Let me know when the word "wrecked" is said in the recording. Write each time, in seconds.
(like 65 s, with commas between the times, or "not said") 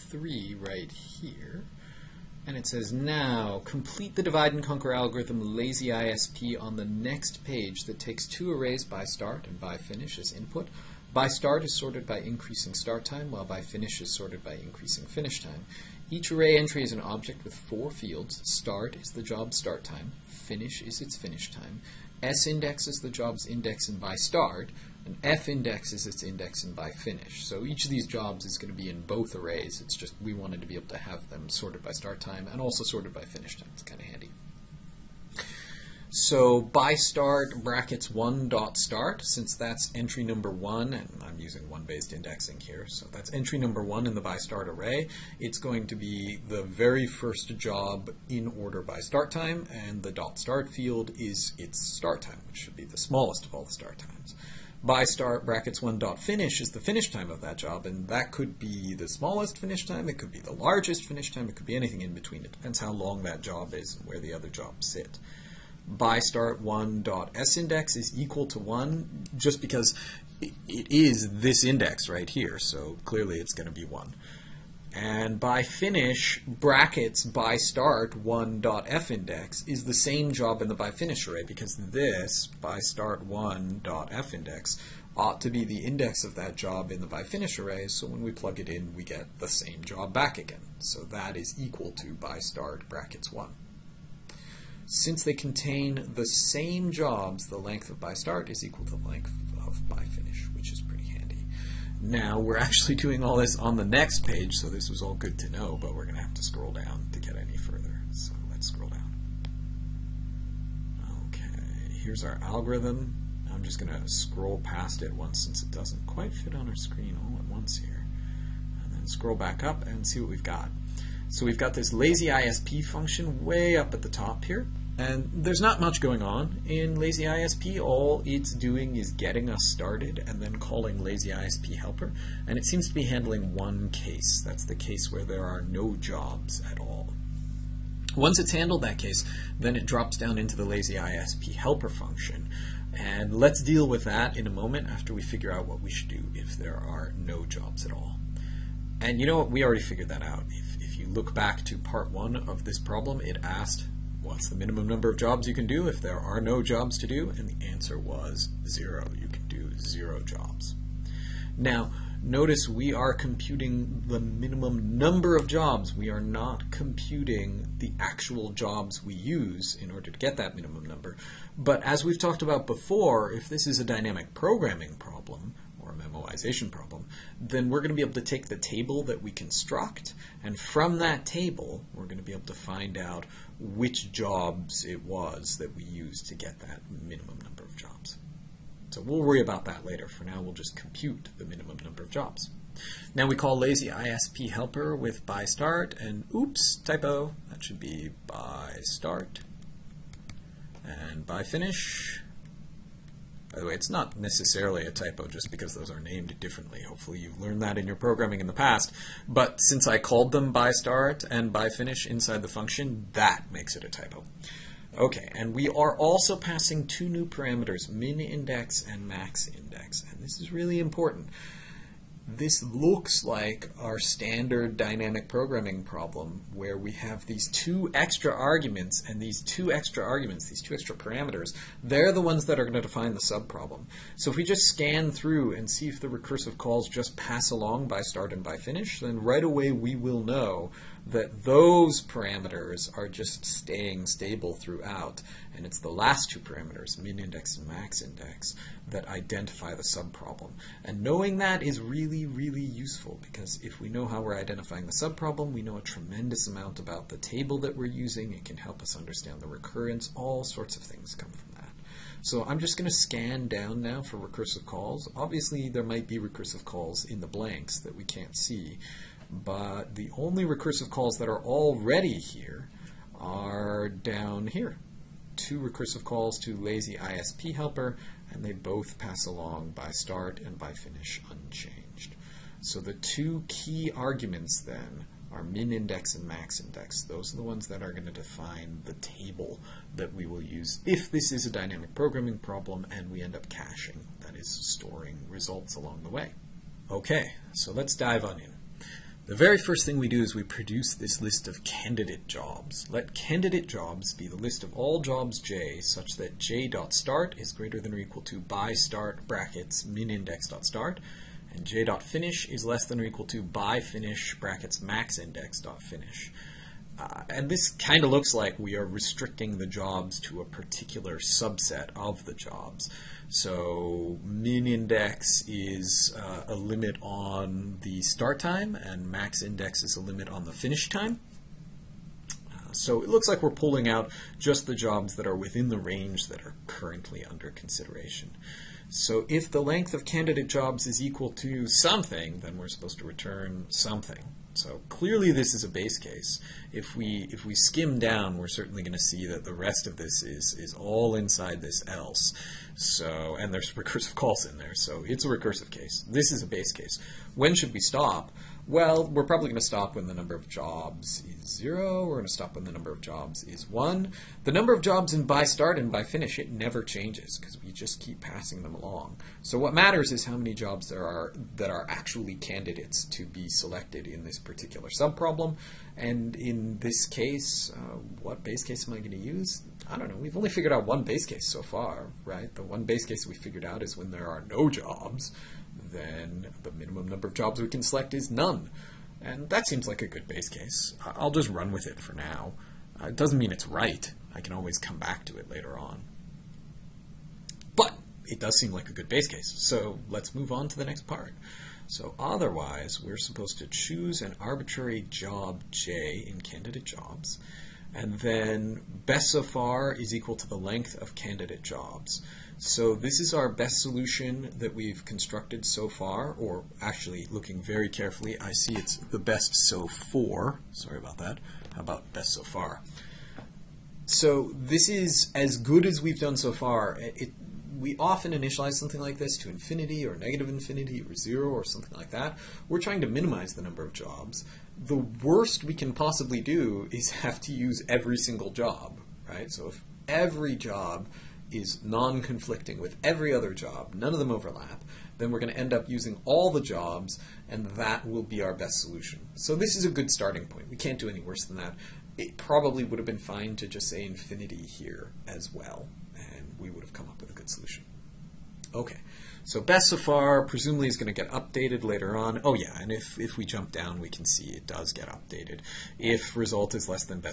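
not said.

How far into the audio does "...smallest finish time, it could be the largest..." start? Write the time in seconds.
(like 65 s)
59 s.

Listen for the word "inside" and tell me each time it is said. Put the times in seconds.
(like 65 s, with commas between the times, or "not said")
212 s, 351 s.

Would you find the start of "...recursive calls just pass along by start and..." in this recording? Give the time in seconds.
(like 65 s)
236 s.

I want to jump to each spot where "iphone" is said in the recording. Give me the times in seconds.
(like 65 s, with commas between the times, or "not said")
not said.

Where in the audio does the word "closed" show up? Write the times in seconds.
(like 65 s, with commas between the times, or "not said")
not said.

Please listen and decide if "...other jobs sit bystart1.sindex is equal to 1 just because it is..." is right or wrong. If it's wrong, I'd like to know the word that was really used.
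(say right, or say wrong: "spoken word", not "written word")
right.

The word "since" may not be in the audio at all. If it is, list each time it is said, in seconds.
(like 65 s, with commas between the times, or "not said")
39 s, 94 s, 115 s, 209 s.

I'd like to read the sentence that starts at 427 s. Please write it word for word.
It, we often initialize something like this to infinity or negative infinity or zero or something like that.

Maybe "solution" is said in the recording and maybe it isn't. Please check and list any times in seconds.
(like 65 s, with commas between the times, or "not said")
413 s, 448 s, 457 s.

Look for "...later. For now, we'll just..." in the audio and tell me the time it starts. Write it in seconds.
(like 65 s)
189 s.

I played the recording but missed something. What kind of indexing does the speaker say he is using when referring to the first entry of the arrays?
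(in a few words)
1-based indexing.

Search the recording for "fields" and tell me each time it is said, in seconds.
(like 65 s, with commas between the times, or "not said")
17 s, 50 s.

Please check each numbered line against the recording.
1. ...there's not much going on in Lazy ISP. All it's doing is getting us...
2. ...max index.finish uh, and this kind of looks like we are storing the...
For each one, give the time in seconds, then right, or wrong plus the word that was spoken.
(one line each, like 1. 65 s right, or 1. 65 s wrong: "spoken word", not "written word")
1. 125 s right
2. 314 s wrong: "restricting", not "storing".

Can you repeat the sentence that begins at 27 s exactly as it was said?
So each of these jobs is going to be in both arrays.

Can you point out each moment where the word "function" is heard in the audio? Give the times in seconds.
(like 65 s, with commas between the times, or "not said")
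122 s, 141 s, 212 s.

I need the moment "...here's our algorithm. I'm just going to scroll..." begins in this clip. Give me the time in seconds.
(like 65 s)
112 s.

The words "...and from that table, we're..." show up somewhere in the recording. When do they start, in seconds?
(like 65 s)
180 s.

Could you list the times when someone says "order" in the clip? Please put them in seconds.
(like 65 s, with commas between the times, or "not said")
48 s, 169 s.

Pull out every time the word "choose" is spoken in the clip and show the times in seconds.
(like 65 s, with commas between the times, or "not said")
403 s.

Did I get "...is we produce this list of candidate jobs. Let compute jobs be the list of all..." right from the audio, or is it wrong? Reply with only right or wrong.
wrong.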